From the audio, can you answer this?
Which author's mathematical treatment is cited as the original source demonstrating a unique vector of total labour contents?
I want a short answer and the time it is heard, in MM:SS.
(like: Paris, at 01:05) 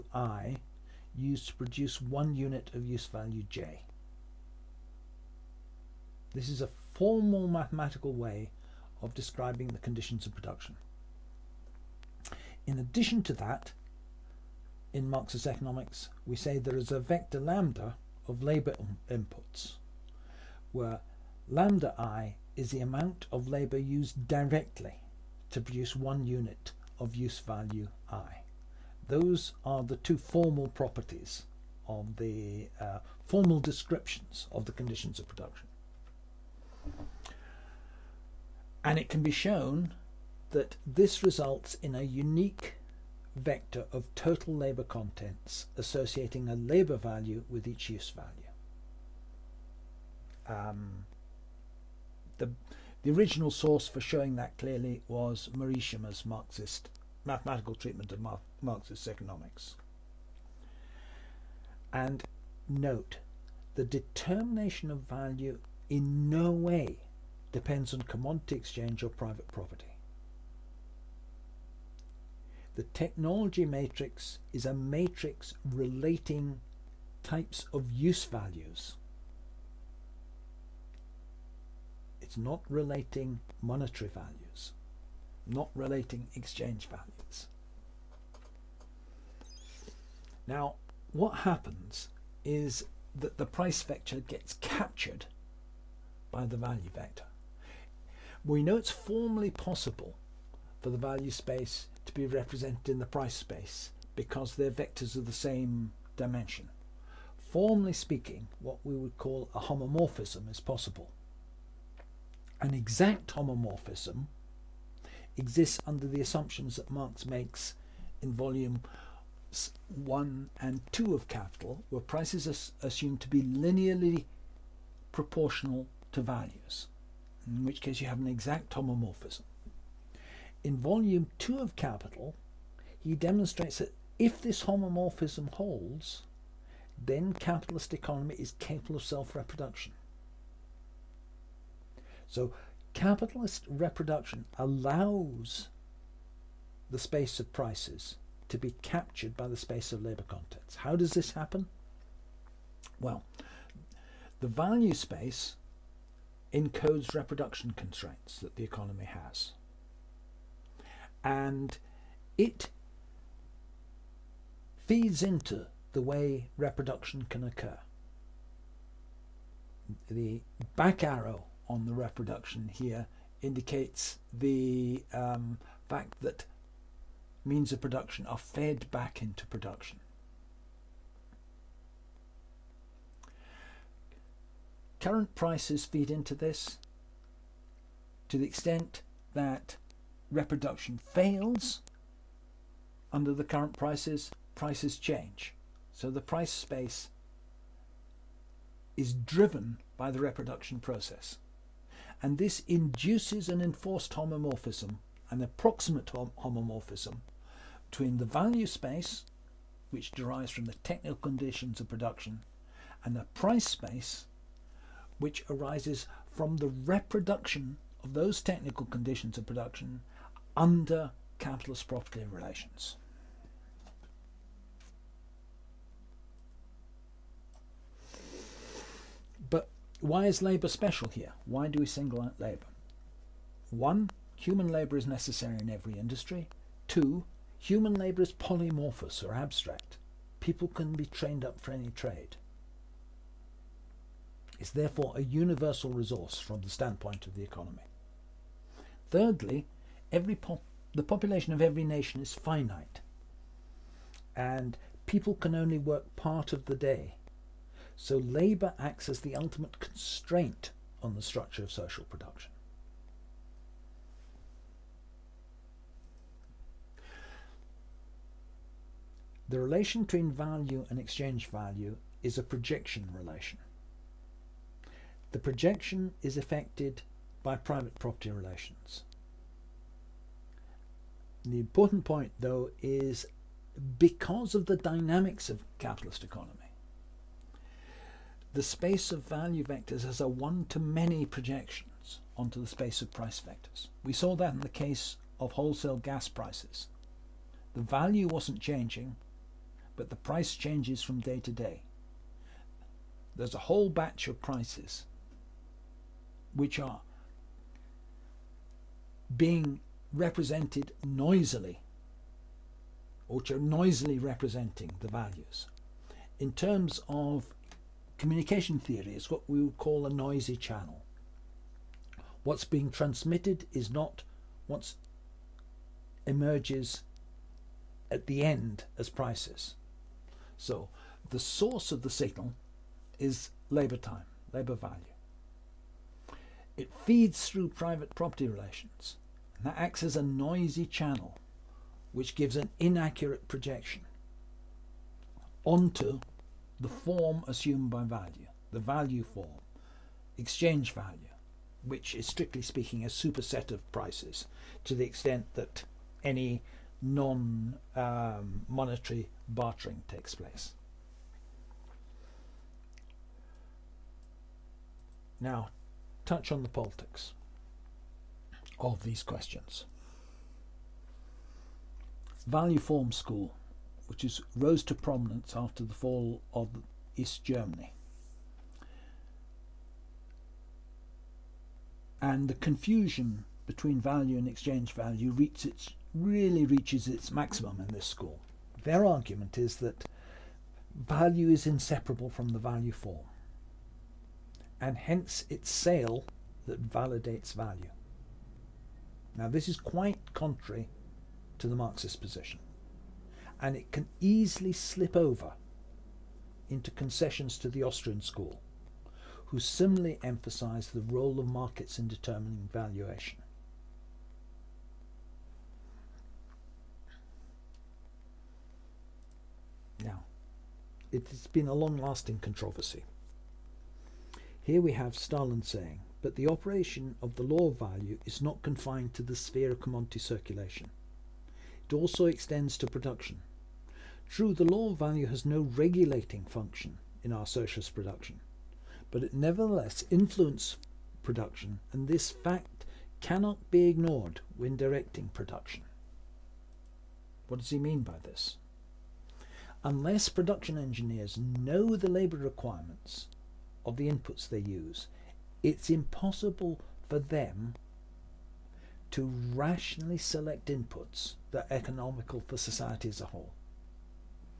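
Morishima, at 00:55.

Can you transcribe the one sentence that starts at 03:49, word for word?
But why is labour special here?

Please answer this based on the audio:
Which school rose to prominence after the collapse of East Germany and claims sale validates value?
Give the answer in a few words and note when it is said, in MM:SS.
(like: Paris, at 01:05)
Value Form School, at 06:12.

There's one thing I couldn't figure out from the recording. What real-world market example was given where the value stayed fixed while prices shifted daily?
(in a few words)
Wholesale gas prices.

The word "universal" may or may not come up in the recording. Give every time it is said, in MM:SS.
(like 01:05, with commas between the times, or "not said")
04:05.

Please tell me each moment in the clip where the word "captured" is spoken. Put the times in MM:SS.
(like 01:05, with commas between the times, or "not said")
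01:34, 02:28.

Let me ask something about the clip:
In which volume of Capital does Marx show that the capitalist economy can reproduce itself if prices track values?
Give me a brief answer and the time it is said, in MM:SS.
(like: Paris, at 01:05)
Volume 2, at 02:10.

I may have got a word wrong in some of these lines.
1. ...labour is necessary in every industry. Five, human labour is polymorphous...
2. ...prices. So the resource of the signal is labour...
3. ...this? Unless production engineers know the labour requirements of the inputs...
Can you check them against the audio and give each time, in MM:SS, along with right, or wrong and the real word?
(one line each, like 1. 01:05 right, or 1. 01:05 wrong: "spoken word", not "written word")
1. 03:54 wrong: "Two", not "Five"
2. 05:29 wrong: "source", not "resource"
3. 07:28 right.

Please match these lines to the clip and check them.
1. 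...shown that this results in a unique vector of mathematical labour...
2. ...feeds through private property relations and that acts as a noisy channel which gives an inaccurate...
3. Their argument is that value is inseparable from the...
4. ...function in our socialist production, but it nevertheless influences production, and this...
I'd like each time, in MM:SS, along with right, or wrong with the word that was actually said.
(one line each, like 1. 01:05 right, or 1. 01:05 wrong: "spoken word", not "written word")
1. 00:39 wrong: "total", not "mathematical"
2. 05:37 right
3. 06:28 right
4. 07:16 right.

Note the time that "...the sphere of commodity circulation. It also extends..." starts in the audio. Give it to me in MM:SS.
07:09.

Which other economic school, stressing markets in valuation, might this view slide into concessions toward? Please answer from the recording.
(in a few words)
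Austrian school.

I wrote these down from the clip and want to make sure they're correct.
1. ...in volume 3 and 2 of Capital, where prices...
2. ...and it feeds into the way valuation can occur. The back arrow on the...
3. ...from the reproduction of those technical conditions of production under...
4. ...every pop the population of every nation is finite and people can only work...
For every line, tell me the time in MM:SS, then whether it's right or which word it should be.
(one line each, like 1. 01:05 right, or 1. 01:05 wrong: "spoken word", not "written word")
1. 01:58 wrong: "1", not "3"
2. 02:41 wrong: "reproduction", not "valuation"
3. 03:36 right
4. 04:10 right.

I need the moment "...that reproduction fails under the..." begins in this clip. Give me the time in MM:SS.
03:09.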